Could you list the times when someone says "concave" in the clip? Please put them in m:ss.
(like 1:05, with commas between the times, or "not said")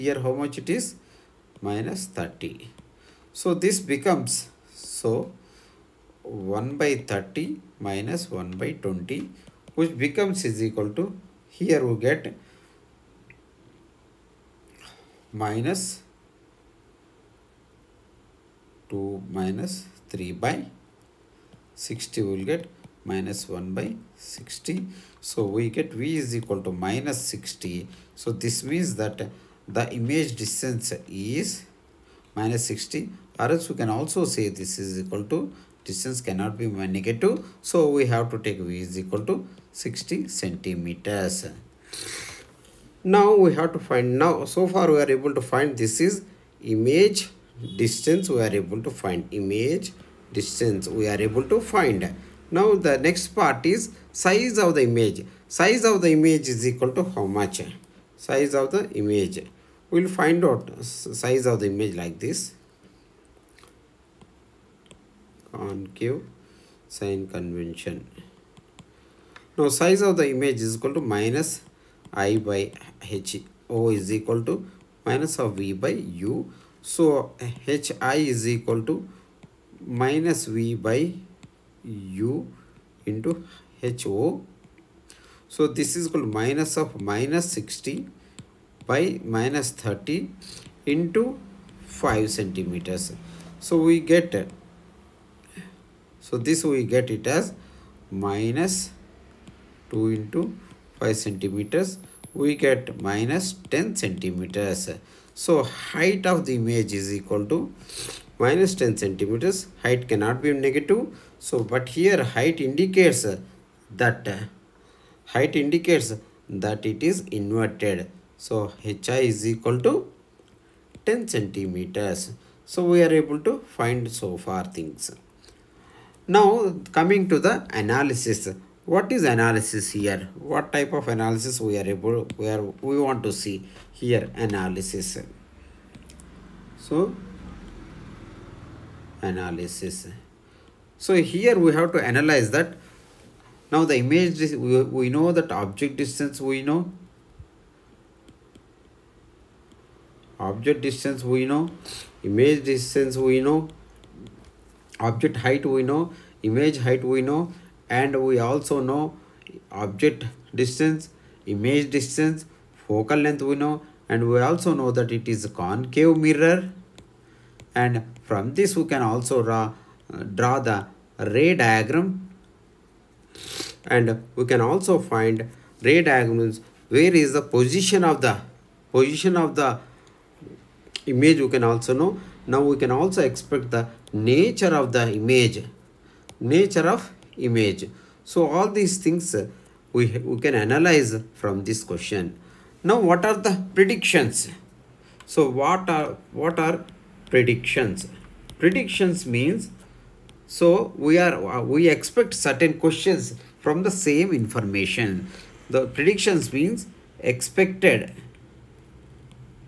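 1:05, 2:45.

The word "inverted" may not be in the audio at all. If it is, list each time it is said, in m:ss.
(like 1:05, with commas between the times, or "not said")
1:57.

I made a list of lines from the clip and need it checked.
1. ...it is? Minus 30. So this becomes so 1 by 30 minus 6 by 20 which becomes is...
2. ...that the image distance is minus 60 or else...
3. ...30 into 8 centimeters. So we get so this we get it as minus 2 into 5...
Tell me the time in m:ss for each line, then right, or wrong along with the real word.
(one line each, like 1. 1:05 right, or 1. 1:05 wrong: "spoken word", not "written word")
1. 0:00 wrong: "1", not "6"
2. 0:29 right
3. 1:29 wrong: "5", not "8".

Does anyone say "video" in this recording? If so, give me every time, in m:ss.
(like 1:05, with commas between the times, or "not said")
not said.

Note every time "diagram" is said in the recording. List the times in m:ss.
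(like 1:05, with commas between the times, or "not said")
2:51, 2:56.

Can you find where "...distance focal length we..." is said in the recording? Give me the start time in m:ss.
2:41.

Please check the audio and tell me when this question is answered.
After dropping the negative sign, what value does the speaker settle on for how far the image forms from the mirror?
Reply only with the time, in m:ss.
0:38.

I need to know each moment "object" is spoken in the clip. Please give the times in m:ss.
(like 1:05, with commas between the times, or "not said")
2:25, 2:30, 2:34, 2:39.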